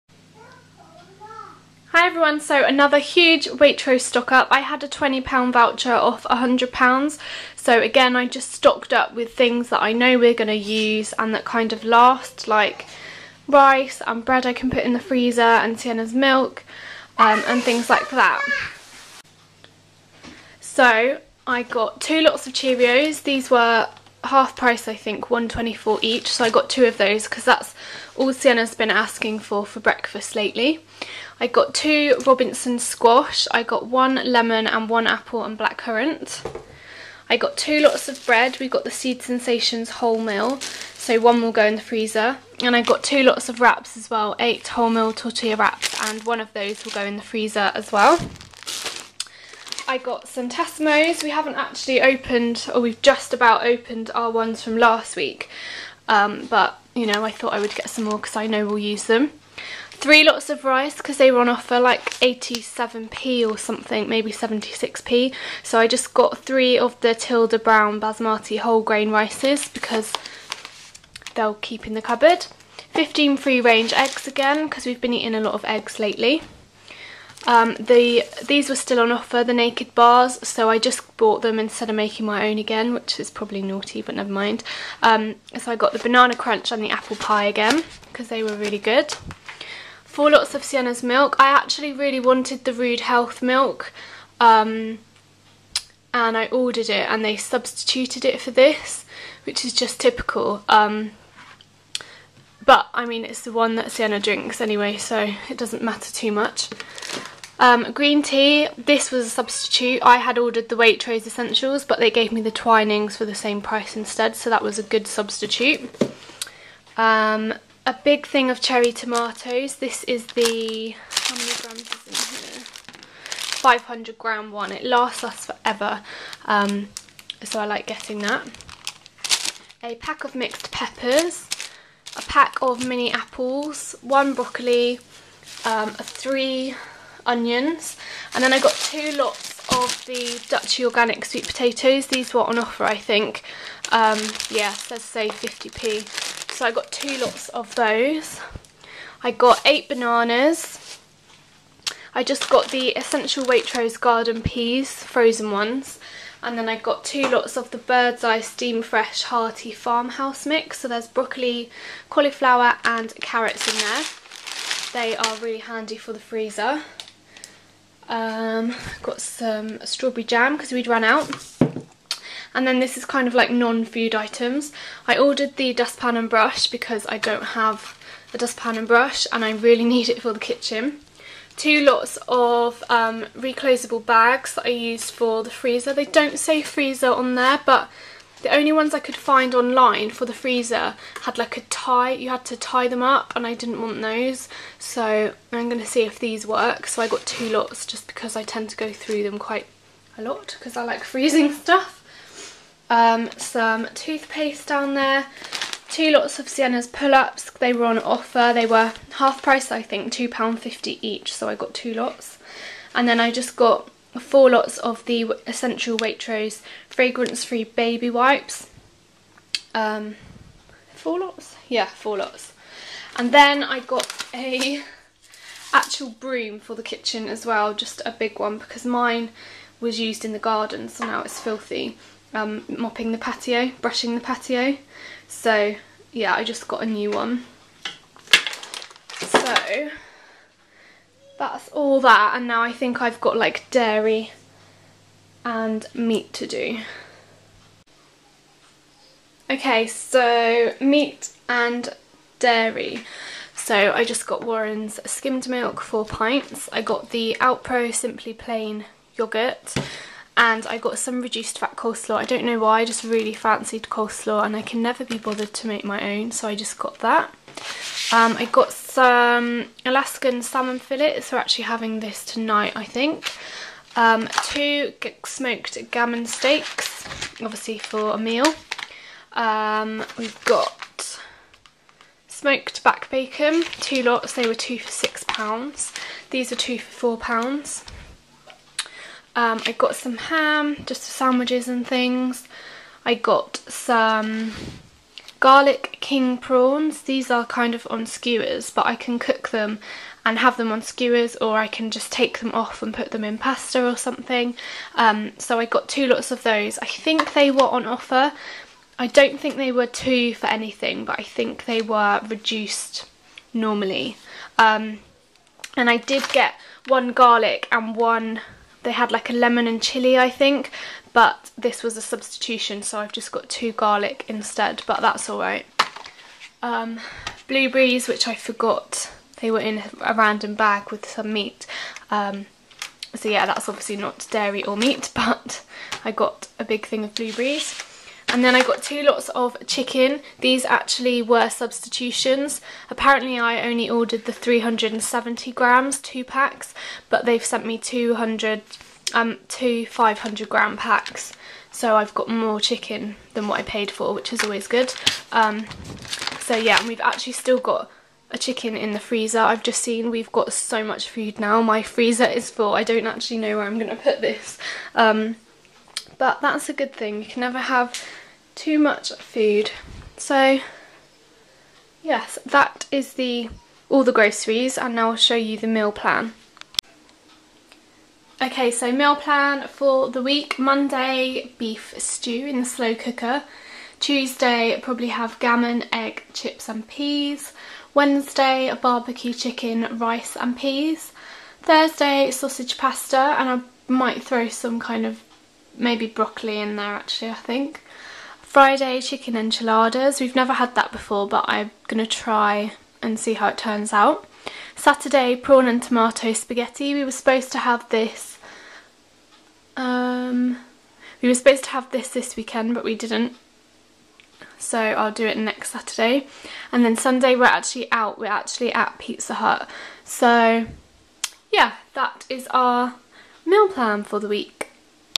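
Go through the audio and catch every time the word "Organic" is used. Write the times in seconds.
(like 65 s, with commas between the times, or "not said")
140 s.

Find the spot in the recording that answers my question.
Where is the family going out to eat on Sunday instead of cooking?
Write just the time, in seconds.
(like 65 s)
418 s.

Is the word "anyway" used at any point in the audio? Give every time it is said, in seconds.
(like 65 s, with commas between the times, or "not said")
104 s.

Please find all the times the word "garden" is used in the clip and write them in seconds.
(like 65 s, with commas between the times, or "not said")
153 s, 230 s.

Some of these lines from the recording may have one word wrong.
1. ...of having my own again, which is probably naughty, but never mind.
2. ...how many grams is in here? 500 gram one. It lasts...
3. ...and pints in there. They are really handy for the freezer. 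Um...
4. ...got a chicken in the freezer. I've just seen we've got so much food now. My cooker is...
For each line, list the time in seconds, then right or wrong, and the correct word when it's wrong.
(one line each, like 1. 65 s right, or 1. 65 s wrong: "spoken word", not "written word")
1. 81 s wrong: "making", not "having"
2. 121 s right
3. 162 s wrong: "carrots", not "pints"
4. 357 s wrong: "freezer", not "cooker".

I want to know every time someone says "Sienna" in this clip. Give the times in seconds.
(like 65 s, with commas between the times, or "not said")
15 s, 28 s, 90 s, 103 s, 206 s.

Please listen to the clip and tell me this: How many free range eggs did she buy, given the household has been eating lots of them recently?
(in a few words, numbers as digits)
15.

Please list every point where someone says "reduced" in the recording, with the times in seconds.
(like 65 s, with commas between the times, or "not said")
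261 s, 312 s.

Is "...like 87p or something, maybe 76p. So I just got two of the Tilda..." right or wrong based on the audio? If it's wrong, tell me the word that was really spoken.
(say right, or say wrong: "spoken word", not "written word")
wrong: "three", not "two".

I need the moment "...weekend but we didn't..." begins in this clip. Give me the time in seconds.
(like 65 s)
412 s.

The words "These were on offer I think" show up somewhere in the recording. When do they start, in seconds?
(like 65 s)
142 s.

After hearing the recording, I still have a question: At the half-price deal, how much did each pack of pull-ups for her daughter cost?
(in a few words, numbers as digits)
£2.50.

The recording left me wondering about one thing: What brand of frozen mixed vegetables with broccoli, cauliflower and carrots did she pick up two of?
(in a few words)
Bird's Eye.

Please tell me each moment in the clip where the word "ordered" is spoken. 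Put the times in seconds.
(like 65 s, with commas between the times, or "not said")
96 s, 110 s, 175 s, 343 s.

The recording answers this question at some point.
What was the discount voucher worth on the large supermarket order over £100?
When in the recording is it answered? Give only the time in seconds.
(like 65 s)
4 s.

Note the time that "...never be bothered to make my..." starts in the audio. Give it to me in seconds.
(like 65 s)
264 s.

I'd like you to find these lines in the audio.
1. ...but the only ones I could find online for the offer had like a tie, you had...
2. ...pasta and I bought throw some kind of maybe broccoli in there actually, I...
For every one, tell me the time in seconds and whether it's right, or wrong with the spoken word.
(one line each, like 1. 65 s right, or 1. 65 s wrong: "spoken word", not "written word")
1. 187 s wrong: "freezer", not "offer"
2. 392 s wrong: "might", not "bought".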